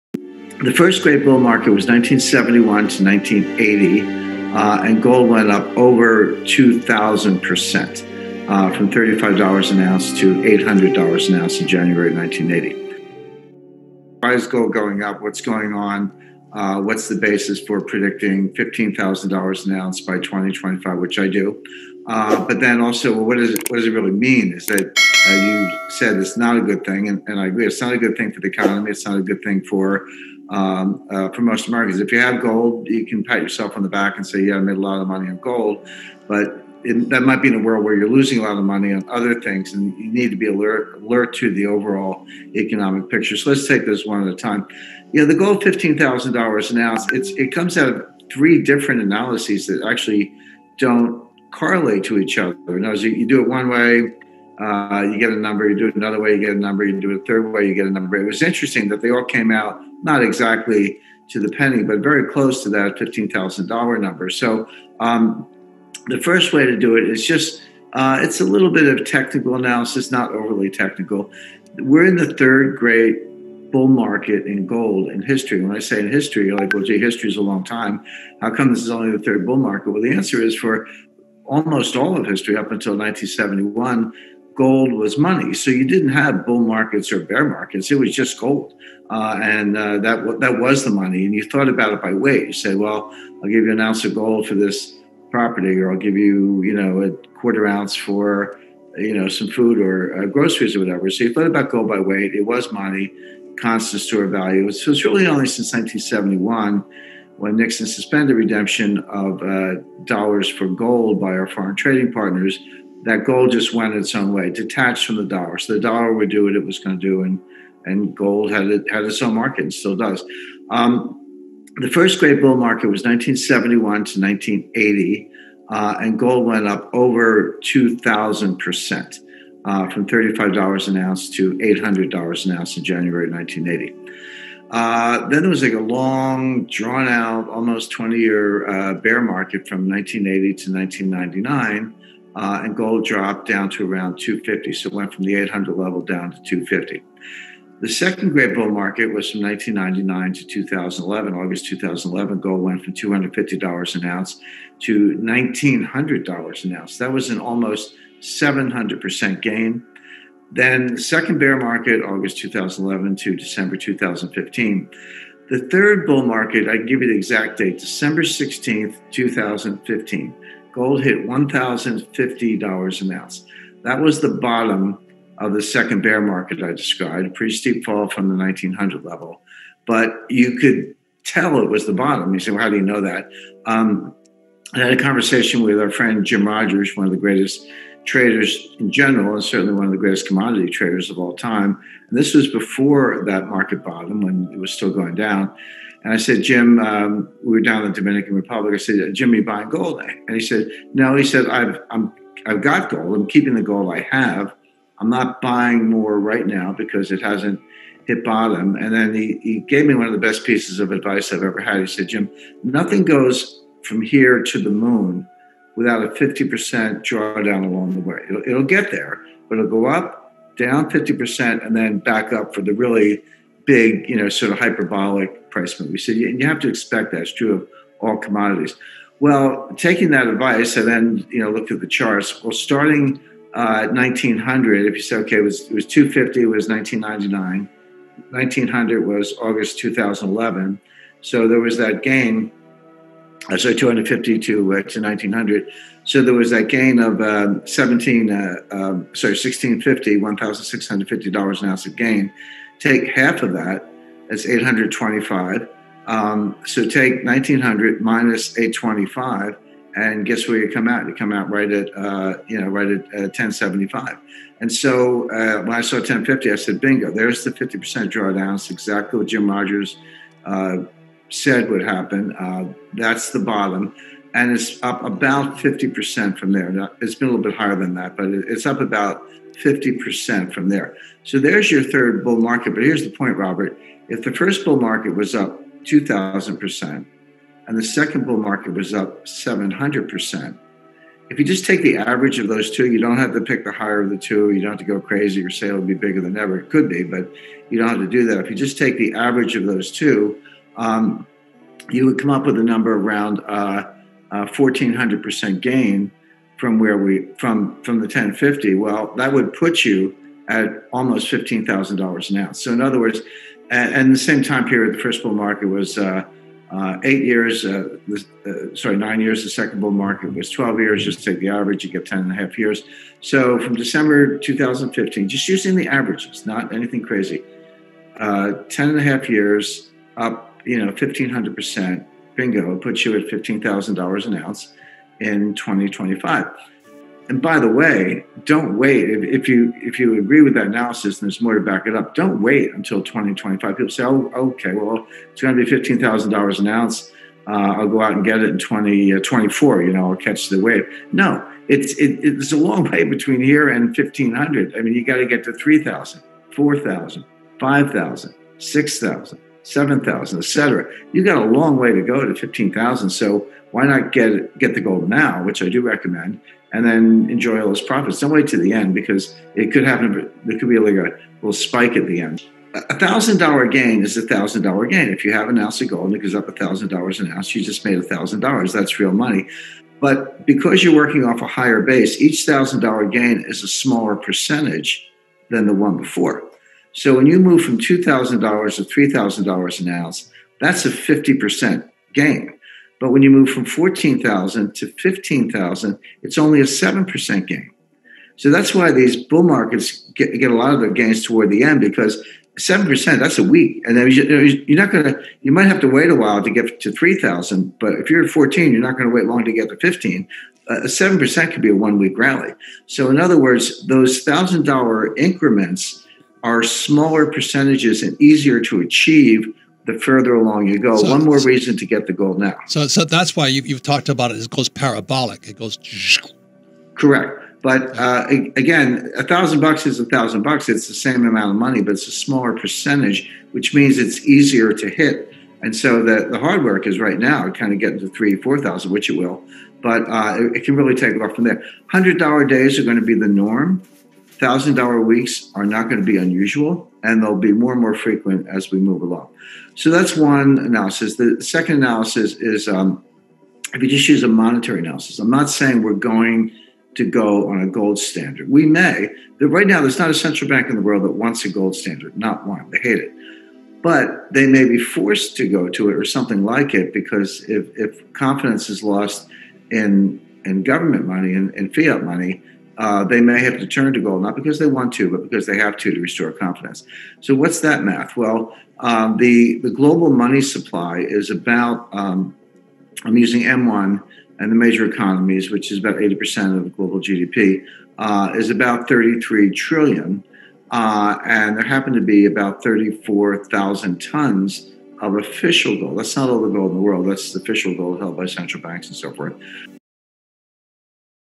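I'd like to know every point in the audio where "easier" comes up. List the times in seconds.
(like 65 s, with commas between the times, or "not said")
418 s, 434 s.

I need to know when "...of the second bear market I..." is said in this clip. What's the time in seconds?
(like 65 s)
175 s.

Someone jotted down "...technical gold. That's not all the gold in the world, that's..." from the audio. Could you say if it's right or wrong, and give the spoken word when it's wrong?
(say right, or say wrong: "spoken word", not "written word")
wrong: "official", not "technical".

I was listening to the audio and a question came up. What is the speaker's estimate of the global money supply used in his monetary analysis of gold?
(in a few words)
33 trillion.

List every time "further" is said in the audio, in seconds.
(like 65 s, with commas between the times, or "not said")
419 s.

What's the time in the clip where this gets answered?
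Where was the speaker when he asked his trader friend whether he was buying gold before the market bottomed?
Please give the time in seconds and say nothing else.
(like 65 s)
197 s.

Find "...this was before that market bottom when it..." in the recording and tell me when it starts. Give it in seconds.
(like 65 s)
192 s.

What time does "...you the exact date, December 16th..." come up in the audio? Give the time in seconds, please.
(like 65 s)
167 s.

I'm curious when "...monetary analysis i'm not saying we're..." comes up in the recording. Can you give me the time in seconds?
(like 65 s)
454 s.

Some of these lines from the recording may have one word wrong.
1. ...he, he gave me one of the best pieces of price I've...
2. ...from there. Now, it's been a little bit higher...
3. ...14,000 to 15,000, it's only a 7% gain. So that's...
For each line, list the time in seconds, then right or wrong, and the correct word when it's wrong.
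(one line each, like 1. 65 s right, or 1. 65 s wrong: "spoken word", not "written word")
1. 209 s wrong: "advice", not "price"
2. 276 s right
3. 393 s right.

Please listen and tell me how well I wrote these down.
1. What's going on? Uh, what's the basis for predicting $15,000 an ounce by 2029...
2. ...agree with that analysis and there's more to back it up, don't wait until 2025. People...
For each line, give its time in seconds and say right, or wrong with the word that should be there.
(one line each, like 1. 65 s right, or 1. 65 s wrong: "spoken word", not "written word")
1. 15 s wrong: "2025", not "2029"
2. 340 s right.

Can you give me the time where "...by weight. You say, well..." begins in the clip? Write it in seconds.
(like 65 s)
92 s.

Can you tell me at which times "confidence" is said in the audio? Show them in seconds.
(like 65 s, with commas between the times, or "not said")
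468 s, 476 s.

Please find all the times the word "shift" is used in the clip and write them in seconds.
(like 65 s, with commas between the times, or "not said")
not said.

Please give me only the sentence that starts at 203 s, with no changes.
I'm keeping the gold I have.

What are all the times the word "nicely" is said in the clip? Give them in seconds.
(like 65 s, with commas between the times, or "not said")
not said.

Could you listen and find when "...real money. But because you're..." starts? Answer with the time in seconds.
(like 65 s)
378 s.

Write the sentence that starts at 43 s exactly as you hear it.
So let's take those one at a time.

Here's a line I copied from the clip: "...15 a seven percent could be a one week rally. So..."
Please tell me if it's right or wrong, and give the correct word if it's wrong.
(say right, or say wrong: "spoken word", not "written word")
right.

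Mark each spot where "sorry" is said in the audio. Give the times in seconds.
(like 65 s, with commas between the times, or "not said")
249 s, 318 s.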